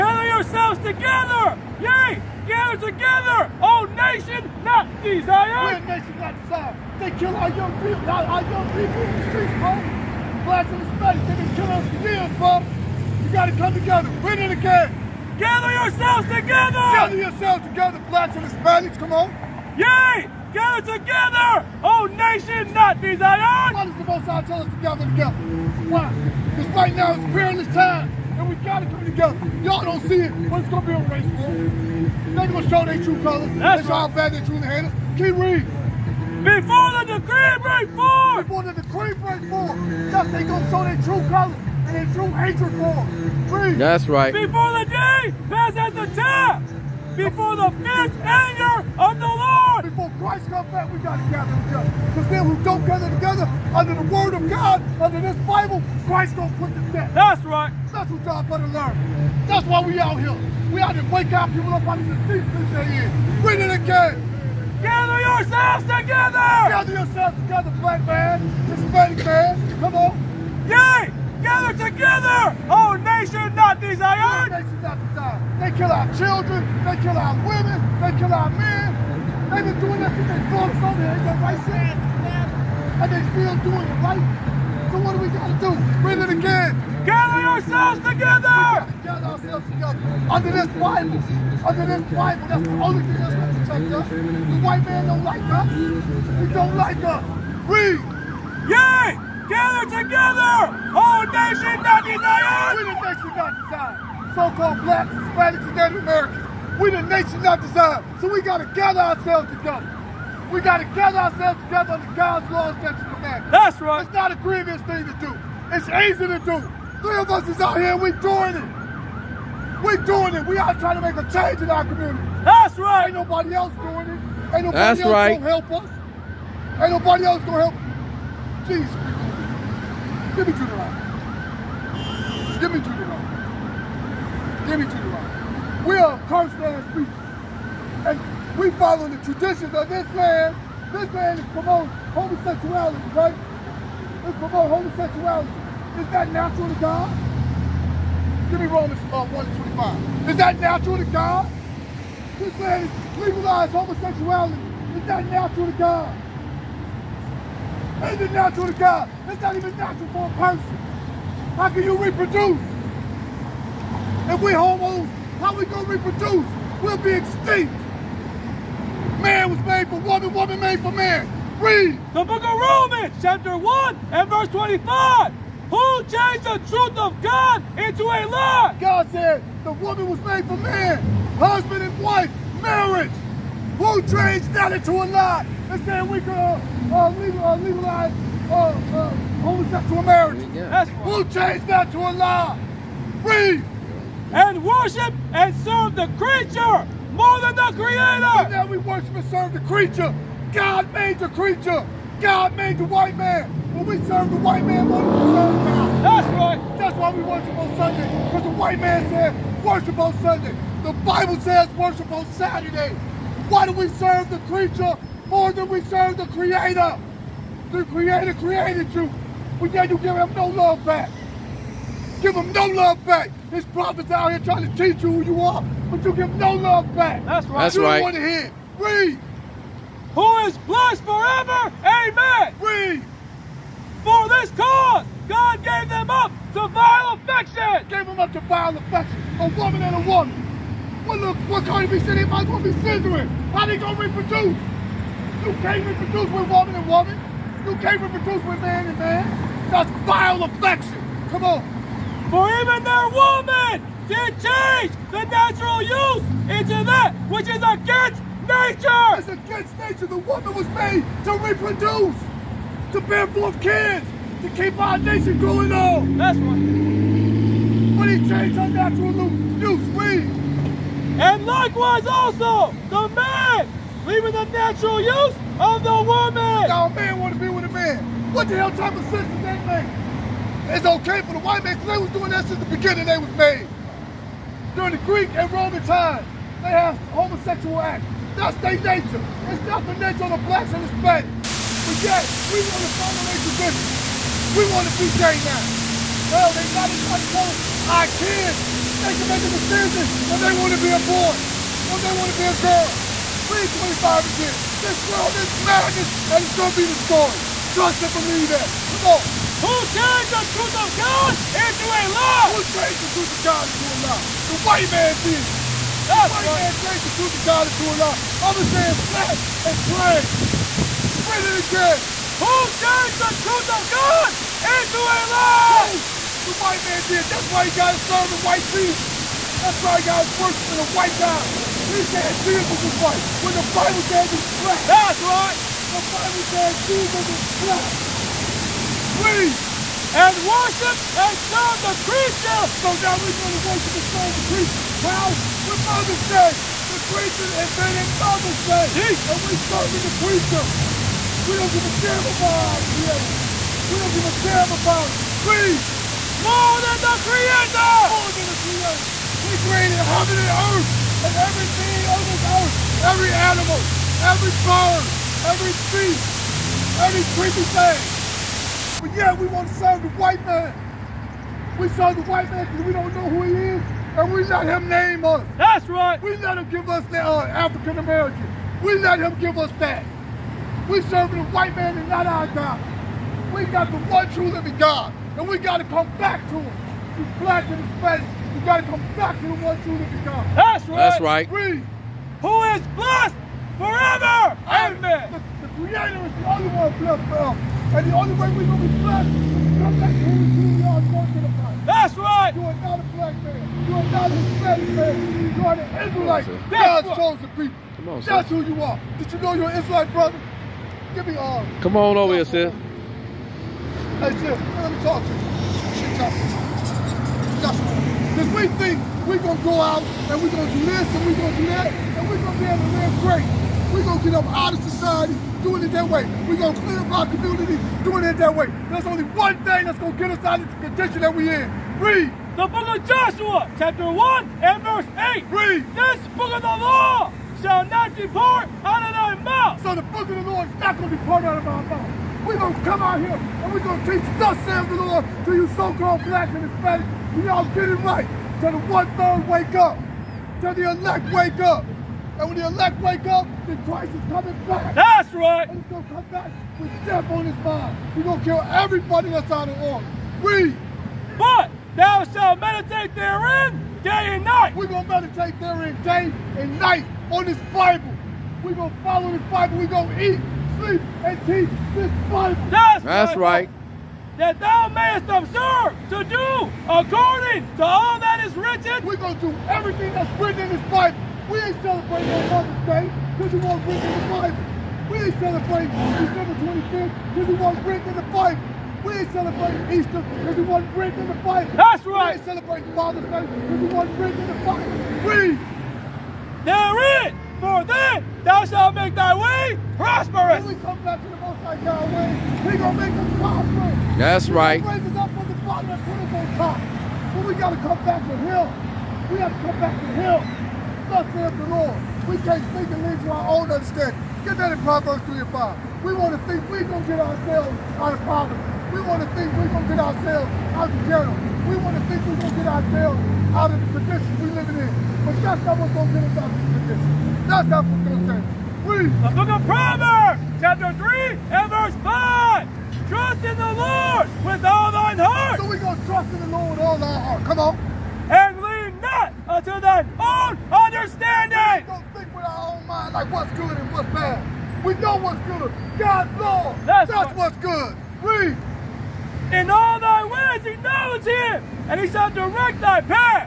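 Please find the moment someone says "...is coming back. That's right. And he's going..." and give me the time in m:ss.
7:34.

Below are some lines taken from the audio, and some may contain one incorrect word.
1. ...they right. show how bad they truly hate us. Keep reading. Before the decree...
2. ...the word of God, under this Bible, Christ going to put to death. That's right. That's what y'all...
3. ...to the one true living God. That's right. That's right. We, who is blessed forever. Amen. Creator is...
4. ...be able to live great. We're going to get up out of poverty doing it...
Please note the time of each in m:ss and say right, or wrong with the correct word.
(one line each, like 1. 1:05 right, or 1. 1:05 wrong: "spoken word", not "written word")
1. 0:33 right
2. 0:53 right
3. 6:29 right
4. 7:02 wrong: "society", not "poverty".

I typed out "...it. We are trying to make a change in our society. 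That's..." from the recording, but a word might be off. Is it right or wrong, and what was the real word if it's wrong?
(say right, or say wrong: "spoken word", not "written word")
wrong: "community", not "society".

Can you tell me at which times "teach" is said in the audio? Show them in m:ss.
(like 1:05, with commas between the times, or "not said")
3:44, 7:24, 7:51.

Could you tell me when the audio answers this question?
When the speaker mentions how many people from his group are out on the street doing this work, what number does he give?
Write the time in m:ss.
1:56.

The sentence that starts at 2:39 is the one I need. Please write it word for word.
It's not even natural for a person.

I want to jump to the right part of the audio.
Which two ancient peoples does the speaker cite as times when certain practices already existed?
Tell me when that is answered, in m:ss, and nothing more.
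4:45.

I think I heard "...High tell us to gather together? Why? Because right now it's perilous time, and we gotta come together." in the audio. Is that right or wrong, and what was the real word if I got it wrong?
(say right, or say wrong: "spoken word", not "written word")
right.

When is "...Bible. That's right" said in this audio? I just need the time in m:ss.
8:11.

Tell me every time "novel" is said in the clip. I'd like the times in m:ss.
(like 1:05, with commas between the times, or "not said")
not said.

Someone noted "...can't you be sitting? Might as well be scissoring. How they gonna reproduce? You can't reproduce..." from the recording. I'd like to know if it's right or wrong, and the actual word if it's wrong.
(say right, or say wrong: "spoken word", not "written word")
right.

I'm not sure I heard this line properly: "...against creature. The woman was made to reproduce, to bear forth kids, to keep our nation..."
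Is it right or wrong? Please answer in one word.
wrong.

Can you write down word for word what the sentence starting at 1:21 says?
They got right there, and they still doing it, right?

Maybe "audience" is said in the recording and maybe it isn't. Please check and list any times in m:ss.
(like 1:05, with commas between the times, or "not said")
not said.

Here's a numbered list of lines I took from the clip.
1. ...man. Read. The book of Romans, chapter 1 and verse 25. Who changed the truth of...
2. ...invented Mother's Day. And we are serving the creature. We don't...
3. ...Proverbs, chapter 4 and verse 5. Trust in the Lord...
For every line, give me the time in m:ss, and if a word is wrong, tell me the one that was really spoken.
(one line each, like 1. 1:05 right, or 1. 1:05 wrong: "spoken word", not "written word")
1. 2:50 right
2. 5:47 right
3. 8:49 wrong: "3", not "4".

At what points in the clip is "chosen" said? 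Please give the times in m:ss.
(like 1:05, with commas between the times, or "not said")
6:47.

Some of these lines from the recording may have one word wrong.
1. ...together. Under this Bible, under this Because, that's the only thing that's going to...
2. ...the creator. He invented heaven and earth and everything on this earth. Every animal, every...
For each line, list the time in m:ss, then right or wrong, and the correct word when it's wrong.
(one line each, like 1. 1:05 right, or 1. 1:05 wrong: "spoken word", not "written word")
1. 1:29 wrong: "Bible", not "Because"
2. 5:58 wrong: "created", not "invented".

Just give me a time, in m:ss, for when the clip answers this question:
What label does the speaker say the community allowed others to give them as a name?
6:17.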